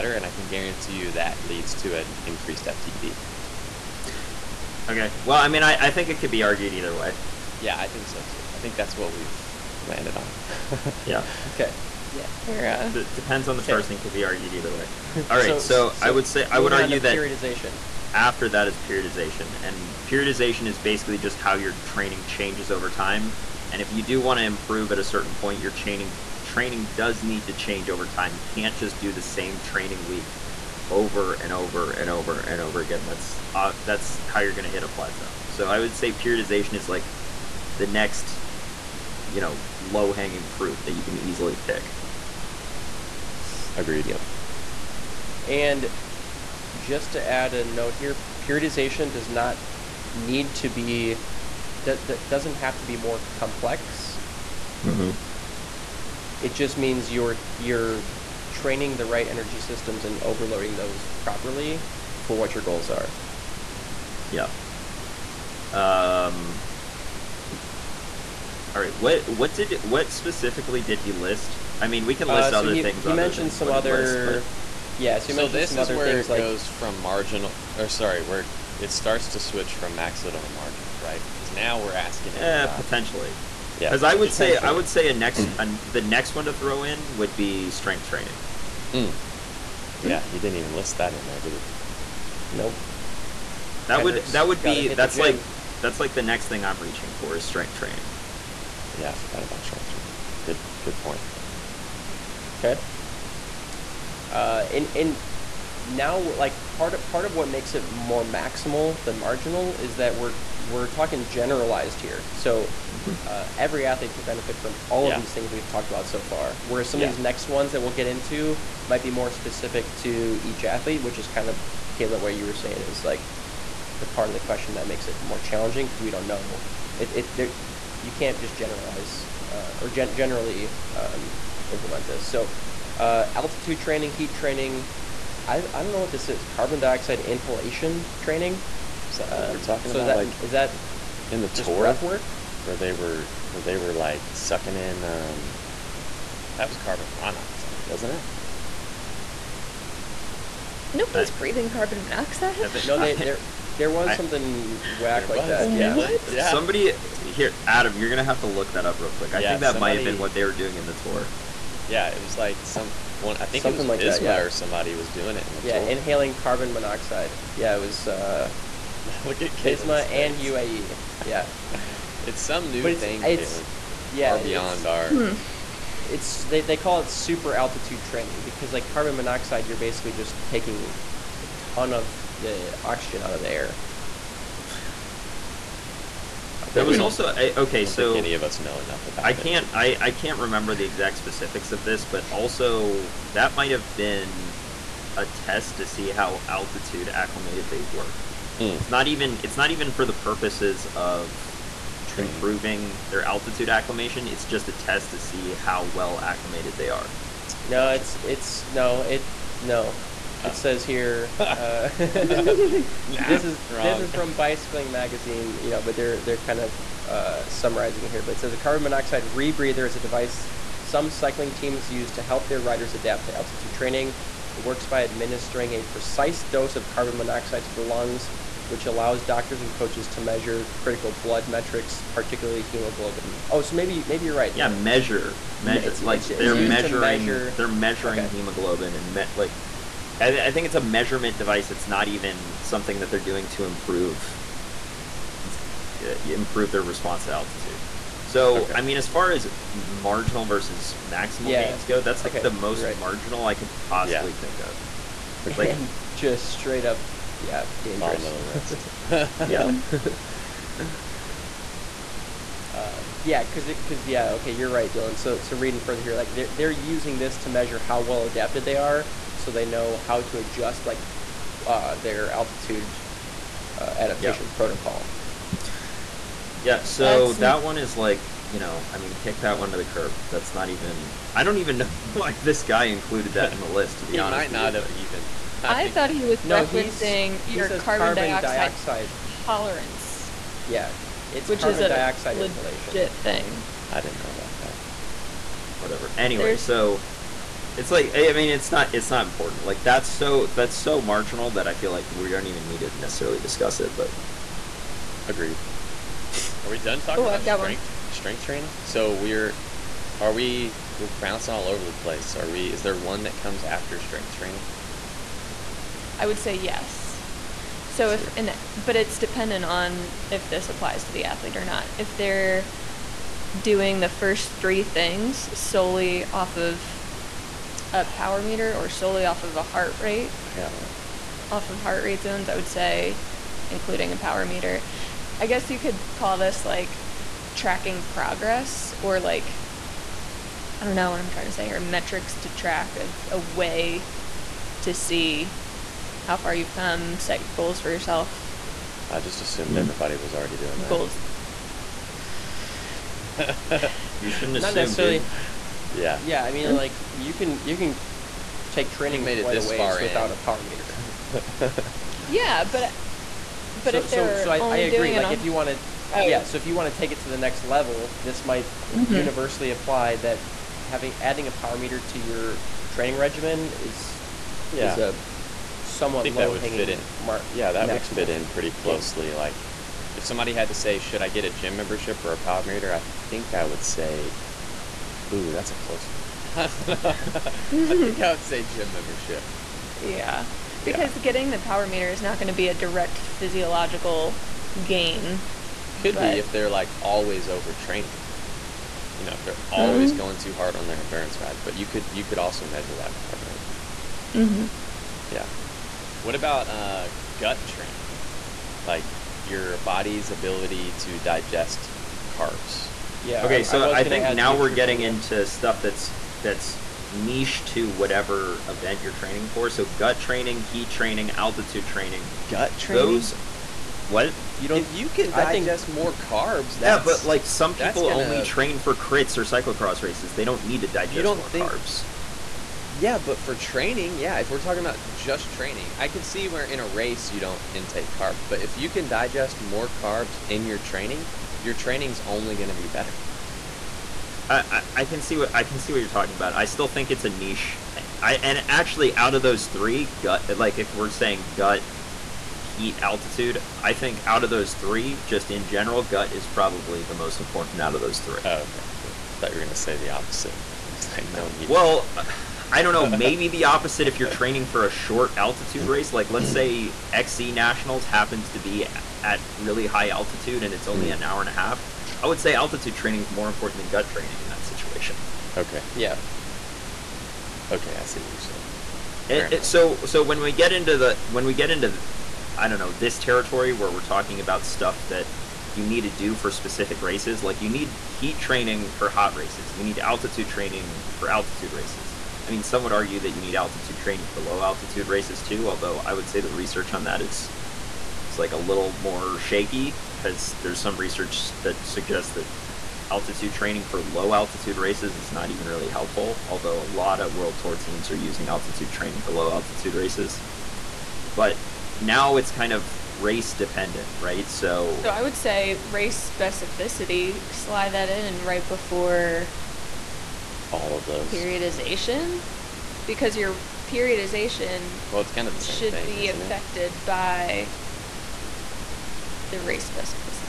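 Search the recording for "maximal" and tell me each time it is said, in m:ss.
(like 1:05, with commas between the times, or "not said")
1:48, 4:11.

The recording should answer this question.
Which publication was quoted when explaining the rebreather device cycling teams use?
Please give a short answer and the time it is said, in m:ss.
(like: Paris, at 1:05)
Bicycling Magazine, at 3:34.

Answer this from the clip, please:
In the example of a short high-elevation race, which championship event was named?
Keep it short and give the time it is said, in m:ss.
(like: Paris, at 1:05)
XC Nationals, at 7:47.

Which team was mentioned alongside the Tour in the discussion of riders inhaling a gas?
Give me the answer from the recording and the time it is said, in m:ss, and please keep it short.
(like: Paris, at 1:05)
UAE, at 2:50.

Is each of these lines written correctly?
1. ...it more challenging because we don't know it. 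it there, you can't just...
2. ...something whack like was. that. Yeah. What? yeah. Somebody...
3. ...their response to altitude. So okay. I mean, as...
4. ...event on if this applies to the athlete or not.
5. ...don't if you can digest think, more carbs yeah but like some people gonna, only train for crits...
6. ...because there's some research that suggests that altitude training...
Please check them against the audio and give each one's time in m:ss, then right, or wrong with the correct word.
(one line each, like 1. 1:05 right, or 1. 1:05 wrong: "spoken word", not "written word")
1. 2:05 right
2. 2:34 right
3. 4:06 right
4. 5:19 wrong: "dependent", not "event"
5. 7:04 right
6. 8:20 right.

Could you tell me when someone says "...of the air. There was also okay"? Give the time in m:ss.
3:03.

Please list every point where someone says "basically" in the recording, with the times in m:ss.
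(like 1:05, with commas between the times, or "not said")
0:20, 2:59.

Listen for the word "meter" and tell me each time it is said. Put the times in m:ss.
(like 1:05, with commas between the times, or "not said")
5:28, 5:34, 6:00, 6:11, 6:22, 6:31.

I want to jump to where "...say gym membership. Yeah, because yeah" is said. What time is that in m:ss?
6:28.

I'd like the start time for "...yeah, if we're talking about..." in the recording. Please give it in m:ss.
7:14.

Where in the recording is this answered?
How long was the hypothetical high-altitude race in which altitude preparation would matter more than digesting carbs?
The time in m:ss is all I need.
7:51.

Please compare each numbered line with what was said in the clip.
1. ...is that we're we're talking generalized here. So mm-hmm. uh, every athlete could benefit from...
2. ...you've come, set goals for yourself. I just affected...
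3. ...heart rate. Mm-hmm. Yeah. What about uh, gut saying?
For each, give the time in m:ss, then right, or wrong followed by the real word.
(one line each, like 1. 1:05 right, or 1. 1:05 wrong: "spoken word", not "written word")
1. 1:49 right
2. 5:46 wrong: "assumed", not "affected"
3. 6:43 wrong: "training", not "saying".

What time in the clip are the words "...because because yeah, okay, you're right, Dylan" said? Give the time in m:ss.
4:23.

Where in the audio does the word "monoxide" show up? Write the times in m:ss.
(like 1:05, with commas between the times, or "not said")
2:27, 2:32, 2:46, 2:59, 3:38, 3:47.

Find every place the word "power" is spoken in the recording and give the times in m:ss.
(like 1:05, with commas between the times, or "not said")
5:28, 5:34, 6:00, 6:11, 6:22, 6:31.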